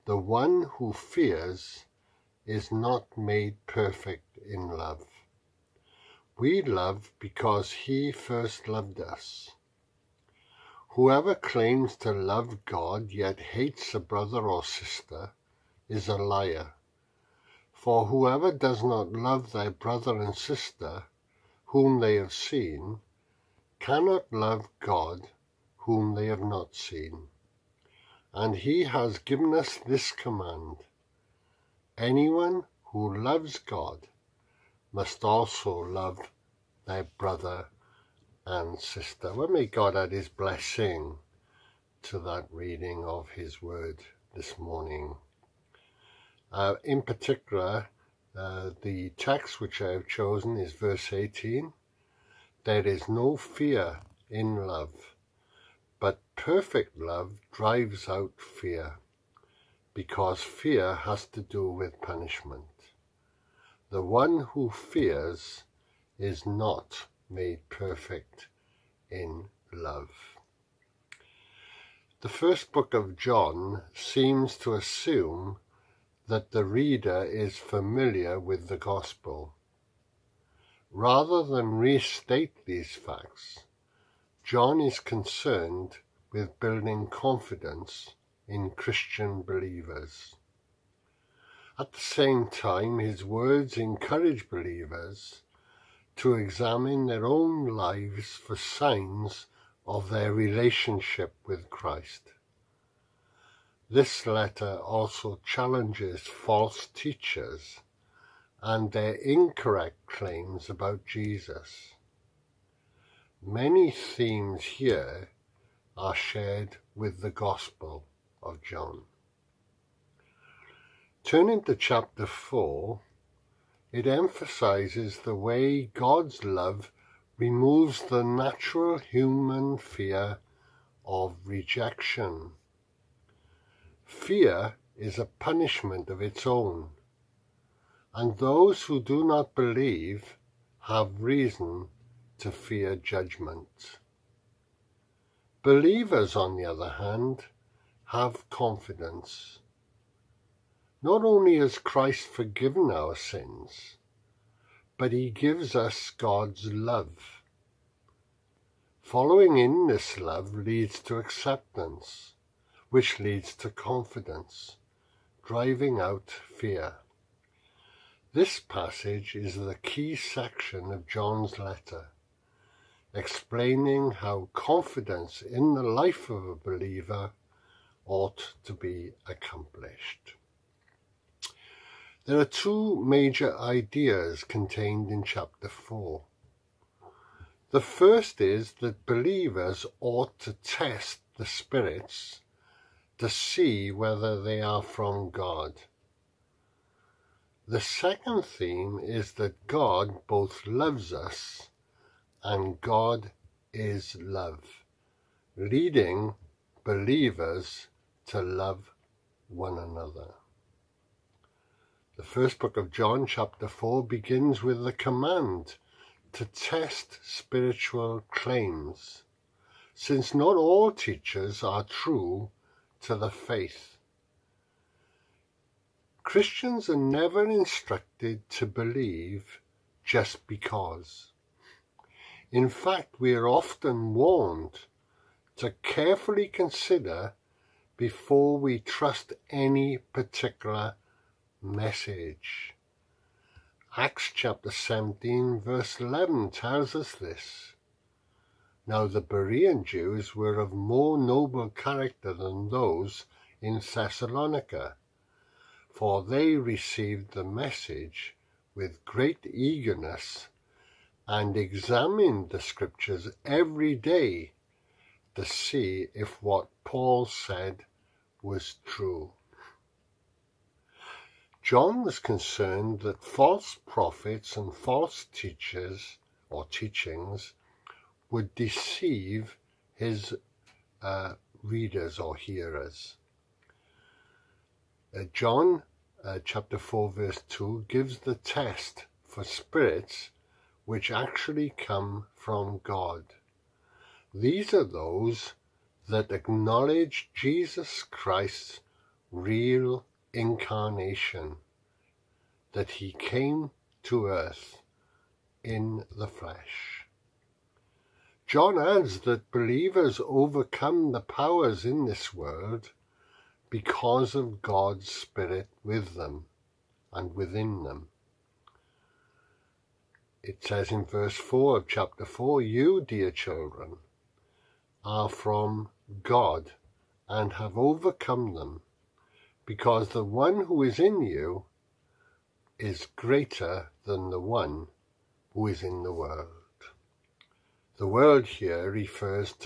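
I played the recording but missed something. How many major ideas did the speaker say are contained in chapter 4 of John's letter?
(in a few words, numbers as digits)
2.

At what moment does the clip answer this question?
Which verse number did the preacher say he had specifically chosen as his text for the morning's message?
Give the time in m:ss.
0:50.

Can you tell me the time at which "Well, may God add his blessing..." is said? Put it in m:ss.
0:39.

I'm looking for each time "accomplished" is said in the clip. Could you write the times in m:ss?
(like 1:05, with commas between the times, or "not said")
2:59.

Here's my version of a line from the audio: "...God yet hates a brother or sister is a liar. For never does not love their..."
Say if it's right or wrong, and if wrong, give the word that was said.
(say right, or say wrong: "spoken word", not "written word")
wrong: "whoever", not "never".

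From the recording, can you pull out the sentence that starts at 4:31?
John was concerned that false prophets and false teachers or teachings would deceive his uh, readers or hearers.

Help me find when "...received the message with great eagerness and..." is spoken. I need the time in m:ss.
4:16.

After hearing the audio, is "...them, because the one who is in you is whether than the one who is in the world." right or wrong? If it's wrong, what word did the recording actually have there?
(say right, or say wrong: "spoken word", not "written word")
wrong: "greater", not "whether".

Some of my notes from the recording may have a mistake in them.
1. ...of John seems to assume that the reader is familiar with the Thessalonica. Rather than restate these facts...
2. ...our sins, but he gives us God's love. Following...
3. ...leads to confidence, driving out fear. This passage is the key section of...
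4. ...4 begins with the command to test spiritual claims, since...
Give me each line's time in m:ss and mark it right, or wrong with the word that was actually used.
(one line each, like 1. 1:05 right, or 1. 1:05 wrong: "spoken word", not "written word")
1. 1:12 wrong: "Gospel", not "Thessalonica"
2. 2:32 right
3. 2:43 right
4. 3:33 right.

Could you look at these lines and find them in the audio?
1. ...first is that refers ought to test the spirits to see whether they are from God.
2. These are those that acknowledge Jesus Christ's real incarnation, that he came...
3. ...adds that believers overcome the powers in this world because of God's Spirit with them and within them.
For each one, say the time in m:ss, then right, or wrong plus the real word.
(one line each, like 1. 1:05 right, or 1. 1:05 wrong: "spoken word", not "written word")
1. 3:07 wrong: "believers", not "refers"
2. 4:54 right
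3. 5:08 right.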